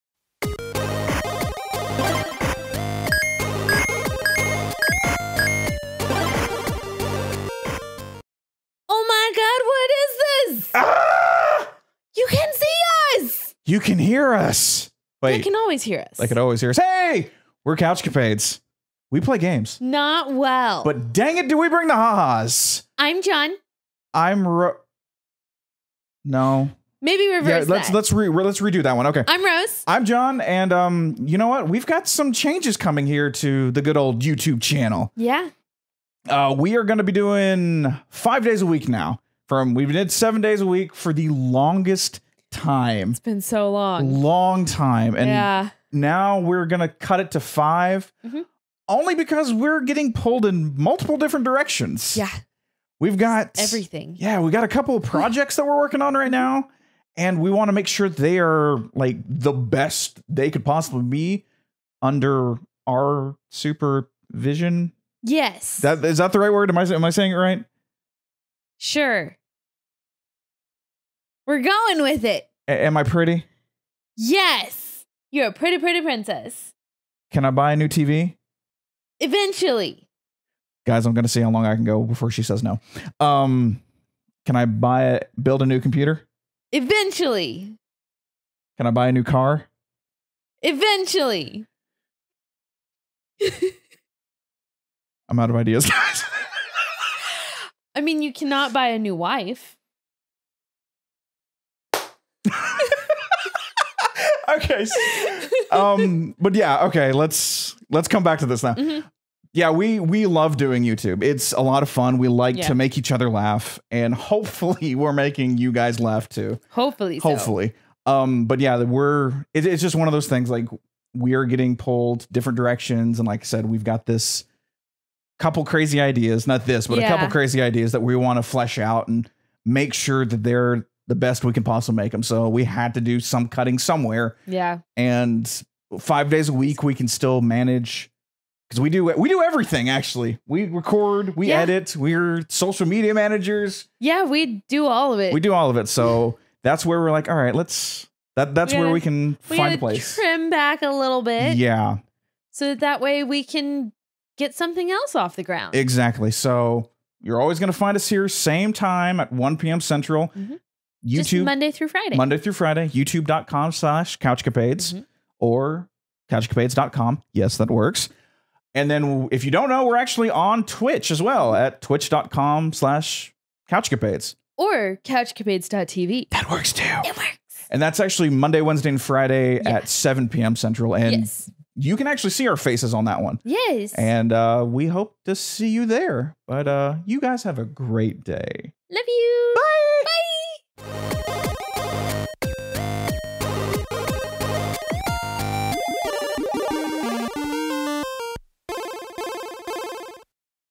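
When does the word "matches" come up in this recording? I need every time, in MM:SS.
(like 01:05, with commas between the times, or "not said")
not said.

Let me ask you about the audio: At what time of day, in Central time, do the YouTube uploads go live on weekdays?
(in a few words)
1 p.m.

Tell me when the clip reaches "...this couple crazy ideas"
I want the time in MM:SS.
02:04.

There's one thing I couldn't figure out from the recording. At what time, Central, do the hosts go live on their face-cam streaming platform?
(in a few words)
7 p.m.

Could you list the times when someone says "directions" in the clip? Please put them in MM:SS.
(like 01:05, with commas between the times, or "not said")
00:51, 02:02.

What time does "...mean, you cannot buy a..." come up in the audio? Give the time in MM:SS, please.
01:37.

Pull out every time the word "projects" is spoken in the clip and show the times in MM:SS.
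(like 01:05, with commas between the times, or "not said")
00:55.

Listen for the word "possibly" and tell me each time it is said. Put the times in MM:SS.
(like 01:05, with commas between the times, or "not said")
01:00, 02:11.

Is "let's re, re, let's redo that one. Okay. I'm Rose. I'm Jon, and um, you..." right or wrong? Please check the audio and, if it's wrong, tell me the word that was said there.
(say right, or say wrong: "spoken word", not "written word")
right.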